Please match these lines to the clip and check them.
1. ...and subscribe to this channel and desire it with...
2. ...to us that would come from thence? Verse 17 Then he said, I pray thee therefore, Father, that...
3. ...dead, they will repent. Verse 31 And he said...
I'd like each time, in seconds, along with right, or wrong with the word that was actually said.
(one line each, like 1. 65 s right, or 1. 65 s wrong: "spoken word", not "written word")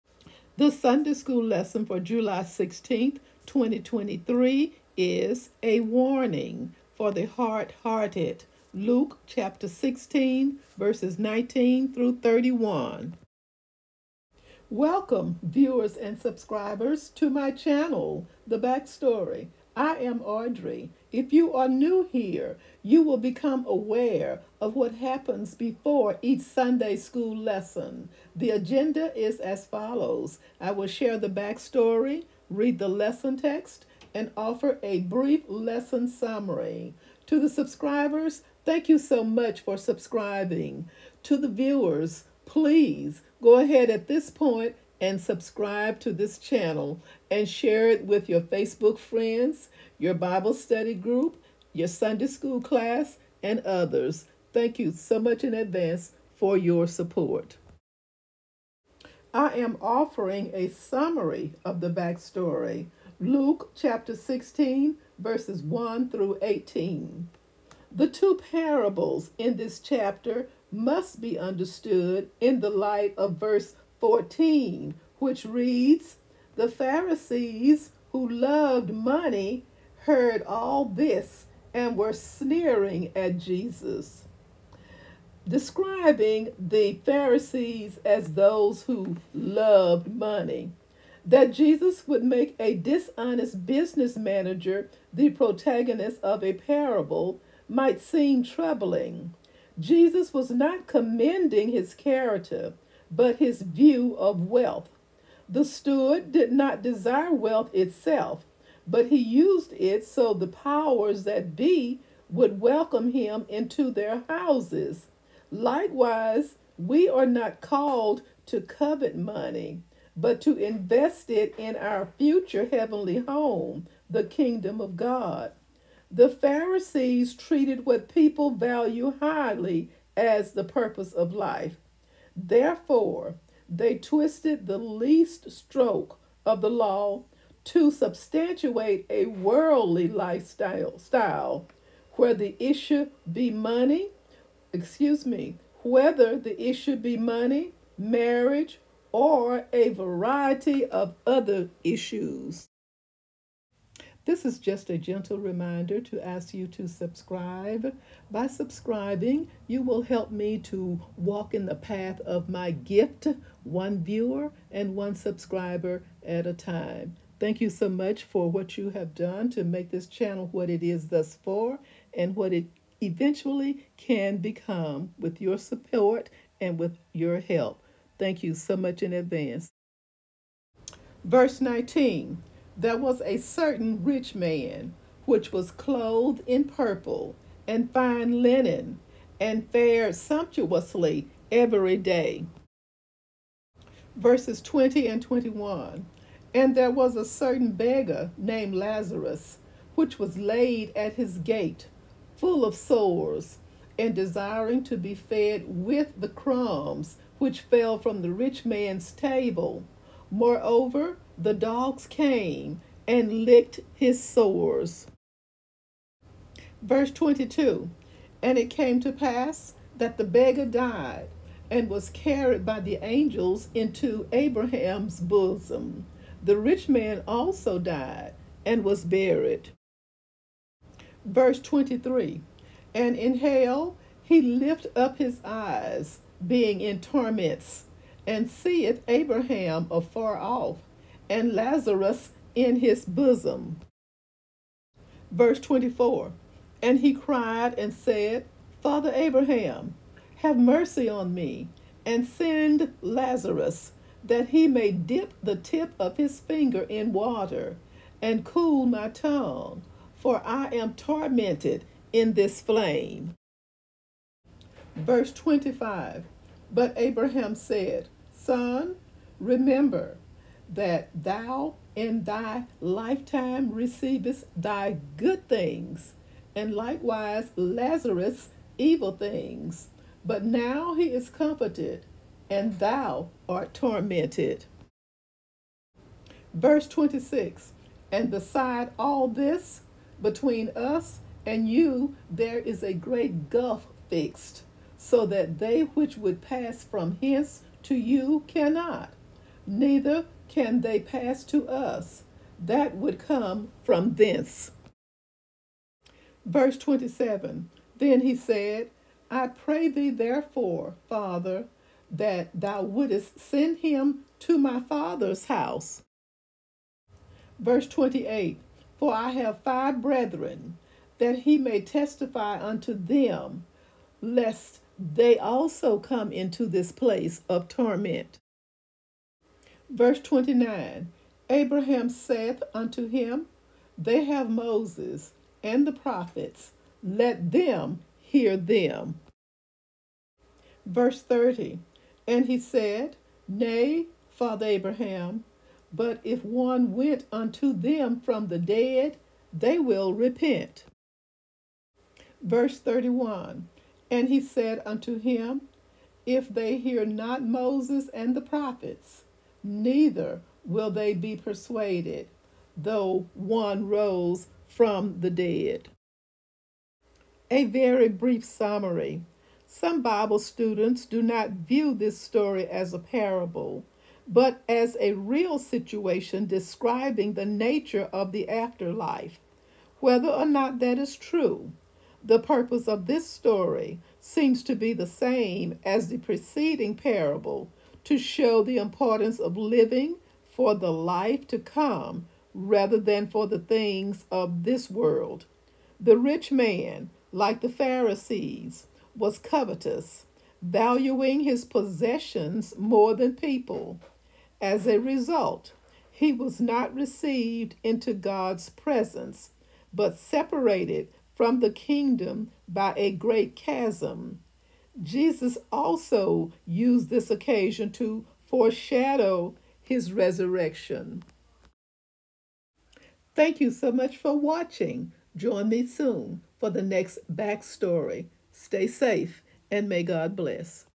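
1. 45 s wrong: "share", not "desire"
2. 301 s wrong: "27", not "17"
3. 348 s right.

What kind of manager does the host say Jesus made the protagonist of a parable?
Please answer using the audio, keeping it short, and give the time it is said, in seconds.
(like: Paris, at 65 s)
dishonest business manager, at 92 s.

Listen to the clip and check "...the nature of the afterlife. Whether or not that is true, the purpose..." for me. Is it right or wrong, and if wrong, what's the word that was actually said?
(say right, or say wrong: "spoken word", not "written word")
right.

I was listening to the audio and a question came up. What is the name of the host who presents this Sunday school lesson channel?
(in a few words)
Audrey.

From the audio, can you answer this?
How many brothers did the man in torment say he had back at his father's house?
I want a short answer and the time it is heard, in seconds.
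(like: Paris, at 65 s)
5, at 319 s.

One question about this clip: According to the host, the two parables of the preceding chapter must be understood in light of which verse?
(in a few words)
verse 14.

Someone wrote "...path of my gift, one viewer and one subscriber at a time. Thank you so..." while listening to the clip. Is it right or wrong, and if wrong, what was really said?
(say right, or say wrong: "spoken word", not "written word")
right.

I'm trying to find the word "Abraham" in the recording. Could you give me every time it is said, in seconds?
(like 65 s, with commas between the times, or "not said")
224 s, 239 s, 249 s, 266 s, 331 s, 344 s.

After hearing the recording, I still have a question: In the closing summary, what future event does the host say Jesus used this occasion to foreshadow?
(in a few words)
his resurrection.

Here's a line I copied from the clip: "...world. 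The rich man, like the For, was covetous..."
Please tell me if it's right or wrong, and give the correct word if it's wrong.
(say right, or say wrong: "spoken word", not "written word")
wrong: "Pharisees", not "For".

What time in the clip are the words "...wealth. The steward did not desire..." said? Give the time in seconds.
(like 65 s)
104 s.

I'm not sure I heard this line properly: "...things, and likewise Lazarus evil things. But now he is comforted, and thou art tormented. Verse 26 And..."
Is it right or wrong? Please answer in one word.
right.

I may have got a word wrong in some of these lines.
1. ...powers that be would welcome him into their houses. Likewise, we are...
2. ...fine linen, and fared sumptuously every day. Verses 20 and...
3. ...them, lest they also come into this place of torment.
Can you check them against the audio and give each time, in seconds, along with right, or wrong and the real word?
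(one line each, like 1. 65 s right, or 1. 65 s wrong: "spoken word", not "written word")
1. 110 s right
2. 187 s right
3. 322 s right.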